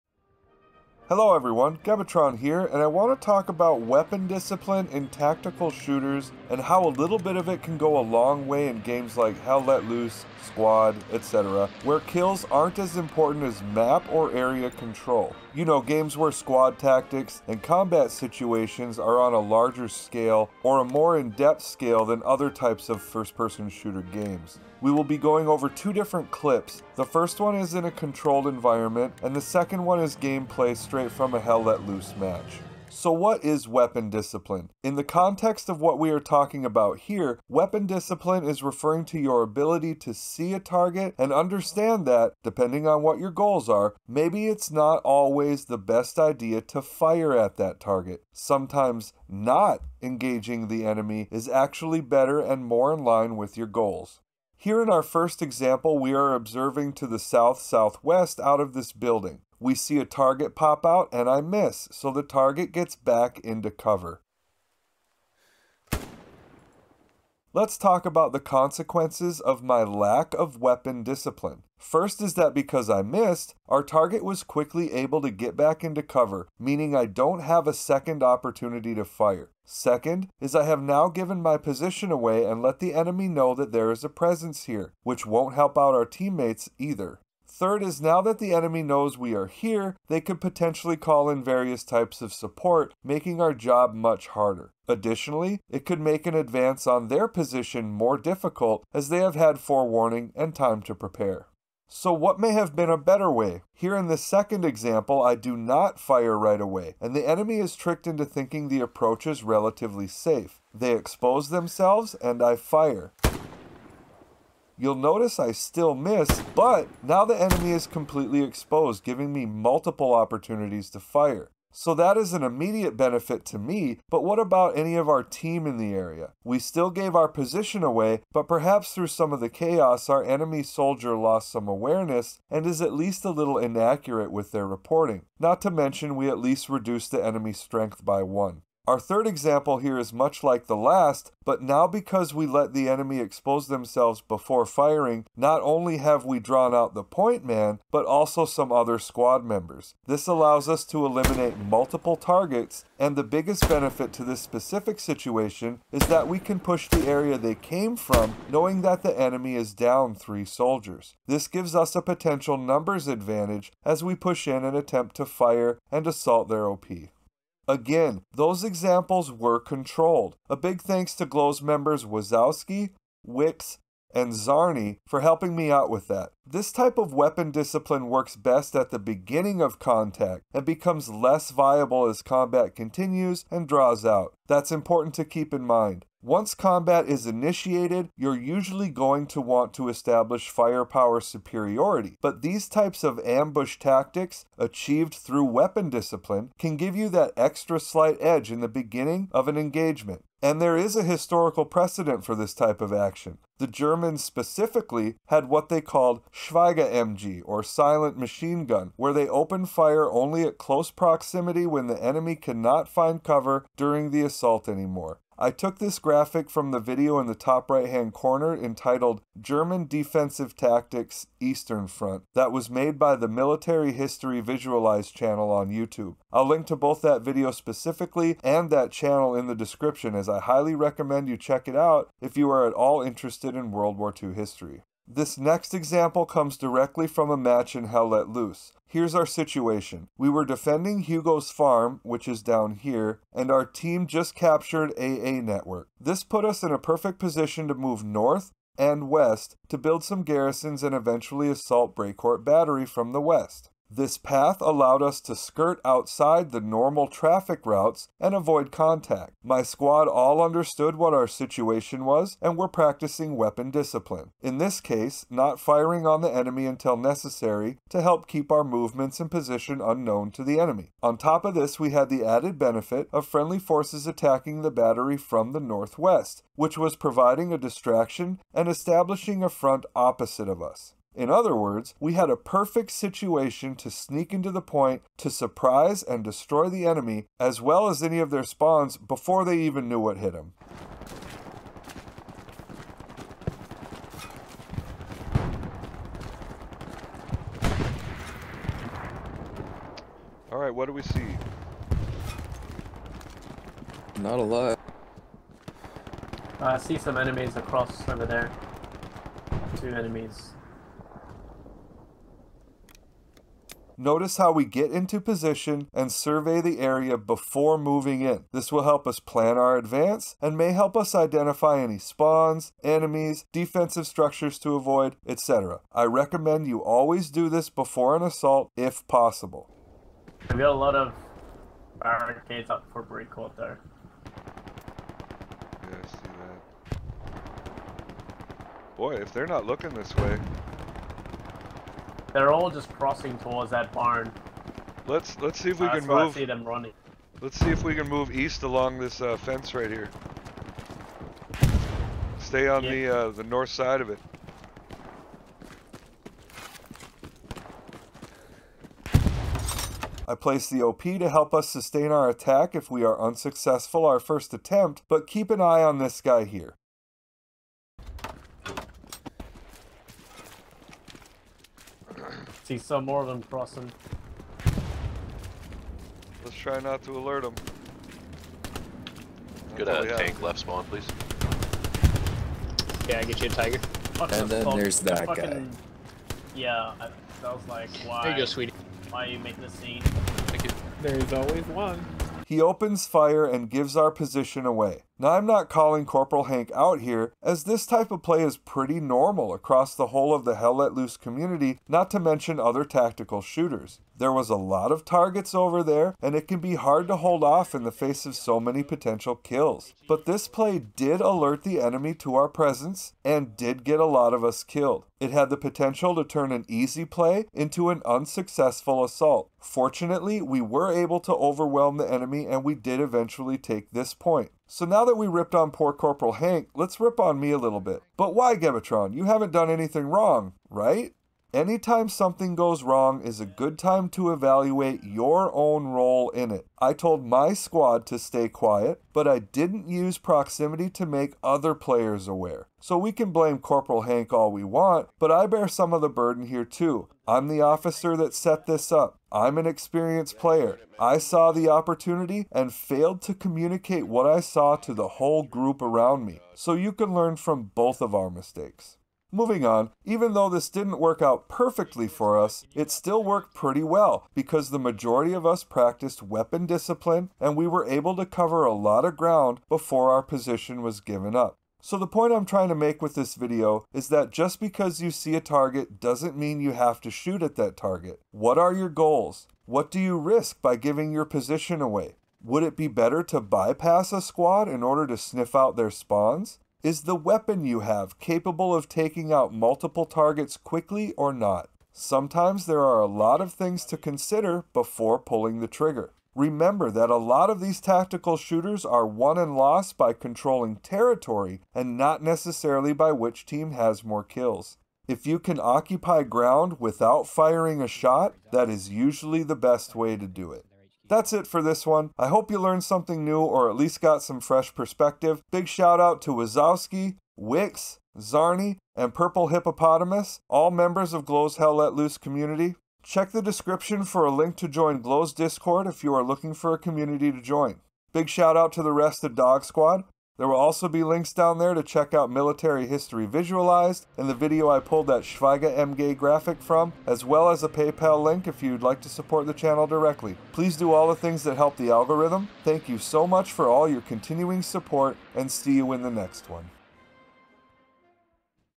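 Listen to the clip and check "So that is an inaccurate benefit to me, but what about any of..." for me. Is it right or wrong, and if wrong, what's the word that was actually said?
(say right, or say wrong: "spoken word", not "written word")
wrong: "immediate", not "inaccurate".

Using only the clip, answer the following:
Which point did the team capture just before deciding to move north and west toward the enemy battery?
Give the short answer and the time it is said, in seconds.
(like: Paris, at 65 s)
AA Network, at 244 s.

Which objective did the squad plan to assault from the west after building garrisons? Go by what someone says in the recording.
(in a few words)
Brécourt Battery.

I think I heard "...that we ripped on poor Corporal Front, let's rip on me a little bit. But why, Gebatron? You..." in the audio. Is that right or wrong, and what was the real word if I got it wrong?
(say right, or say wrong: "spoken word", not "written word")
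wrong: "Hank", not "Front".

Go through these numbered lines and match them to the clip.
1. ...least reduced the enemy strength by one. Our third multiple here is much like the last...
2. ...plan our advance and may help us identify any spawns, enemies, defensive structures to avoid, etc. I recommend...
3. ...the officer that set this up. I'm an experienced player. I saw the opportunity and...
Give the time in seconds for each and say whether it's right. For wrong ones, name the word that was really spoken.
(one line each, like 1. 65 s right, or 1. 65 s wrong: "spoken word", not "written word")
1. 136 s wrong: "example", not "multiple"
2. 319 s right
3. 447 s right.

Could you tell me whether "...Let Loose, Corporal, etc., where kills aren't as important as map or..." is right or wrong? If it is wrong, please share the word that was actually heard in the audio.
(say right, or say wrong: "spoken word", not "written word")
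wrong: "Squad", not "Corporal".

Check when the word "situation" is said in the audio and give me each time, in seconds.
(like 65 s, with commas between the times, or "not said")
18 s, 154 s, 239 s, 261 s, 282 s.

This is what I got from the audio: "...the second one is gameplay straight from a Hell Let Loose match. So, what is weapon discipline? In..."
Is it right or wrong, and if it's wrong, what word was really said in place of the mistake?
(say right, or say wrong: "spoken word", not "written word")
right.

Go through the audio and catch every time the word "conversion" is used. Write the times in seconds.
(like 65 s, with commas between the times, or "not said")
not said.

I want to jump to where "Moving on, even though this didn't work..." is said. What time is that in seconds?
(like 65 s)
459 s.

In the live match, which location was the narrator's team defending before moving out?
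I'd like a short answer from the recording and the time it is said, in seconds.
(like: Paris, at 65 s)
Hugo's farm, at 241 s.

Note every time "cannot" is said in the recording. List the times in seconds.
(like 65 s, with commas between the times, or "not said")
212 s.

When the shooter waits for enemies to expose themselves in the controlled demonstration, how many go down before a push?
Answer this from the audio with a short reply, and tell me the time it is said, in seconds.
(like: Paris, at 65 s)
3, at 160 s.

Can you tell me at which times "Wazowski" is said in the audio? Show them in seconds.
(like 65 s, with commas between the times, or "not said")
172 s, 516 s.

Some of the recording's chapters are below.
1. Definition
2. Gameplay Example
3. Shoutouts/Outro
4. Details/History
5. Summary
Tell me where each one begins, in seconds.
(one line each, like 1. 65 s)
1. 32 s
2. 234 s
3. 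510 s
4. 167 s
5. 471 s.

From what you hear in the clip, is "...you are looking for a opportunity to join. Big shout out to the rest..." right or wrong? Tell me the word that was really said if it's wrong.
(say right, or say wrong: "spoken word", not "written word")
wrong: "community", not "opportunity".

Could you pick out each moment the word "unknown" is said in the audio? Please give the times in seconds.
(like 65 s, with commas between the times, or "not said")
269 s.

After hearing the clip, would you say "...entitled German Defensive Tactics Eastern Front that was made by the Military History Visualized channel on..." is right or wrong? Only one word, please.
right.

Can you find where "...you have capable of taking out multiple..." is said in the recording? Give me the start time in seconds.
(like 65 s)
487 s.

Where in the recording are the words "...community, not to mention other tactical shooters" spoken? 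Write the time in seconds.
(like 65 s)
401 s.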